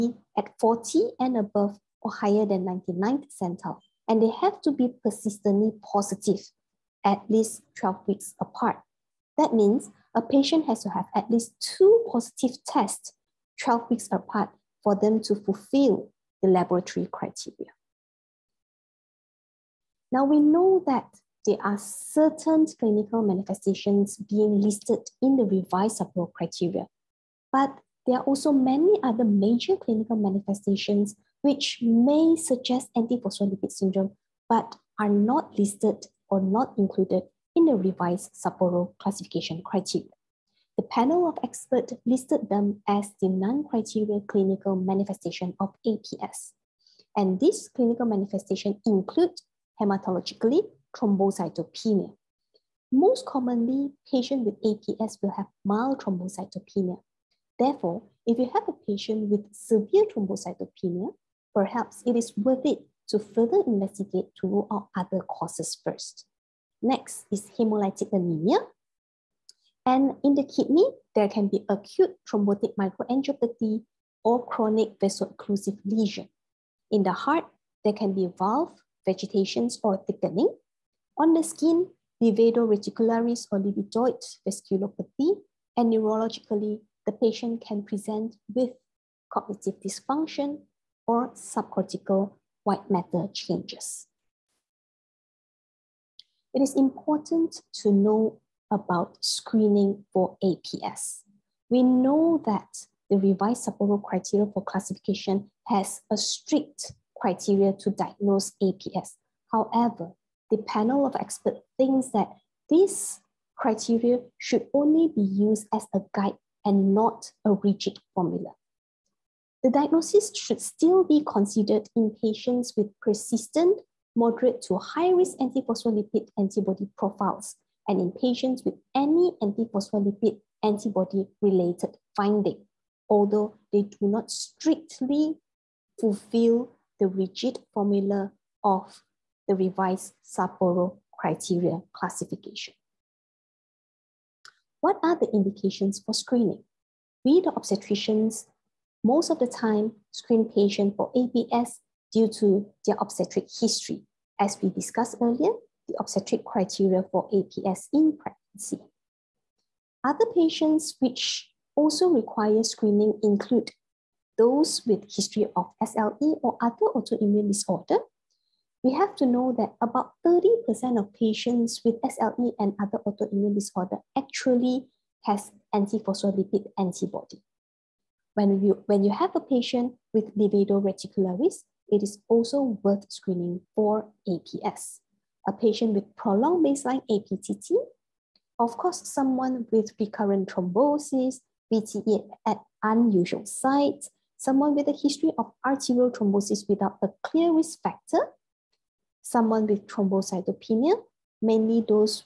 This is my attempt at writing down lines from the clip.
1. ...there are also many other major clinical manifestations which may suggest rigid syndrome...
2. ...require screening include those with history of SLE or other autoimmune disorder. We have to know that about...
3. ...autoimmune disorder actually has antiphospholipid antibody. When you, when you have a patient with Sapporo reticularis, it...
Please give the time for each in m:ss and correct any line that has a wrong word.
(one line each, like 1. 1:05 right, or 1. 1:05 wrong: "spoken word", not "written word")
1. 0:28 wrong: "antiphospholipid", not "rigid"
2. 2:42 right
3. 2:53 wrong: "Livedo", not "Sapporo".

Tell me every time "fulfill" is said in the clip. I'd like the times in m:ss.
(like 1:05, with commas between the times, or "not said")
0:15, 2:15.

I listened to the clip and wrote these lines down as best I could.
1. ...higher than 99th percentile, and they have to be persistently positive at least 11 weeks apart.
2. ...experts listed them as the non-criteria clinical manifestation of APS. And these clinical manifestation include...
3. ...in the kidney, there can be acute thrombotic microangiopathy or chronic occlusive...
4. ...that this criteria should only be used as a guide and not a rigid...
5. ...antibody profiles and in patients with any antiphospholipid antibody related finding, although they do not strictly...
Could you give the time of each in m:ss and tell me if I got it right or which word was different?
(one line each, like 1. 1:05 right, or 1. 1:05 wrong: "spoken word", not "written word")
1. 0:02 wrong: "12", not "11"
2. 0:41 right
3. 1:10 right
4. 1:52 right
5. 2:06 right.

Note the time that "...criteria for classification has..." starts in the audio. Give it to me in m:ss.
1:44.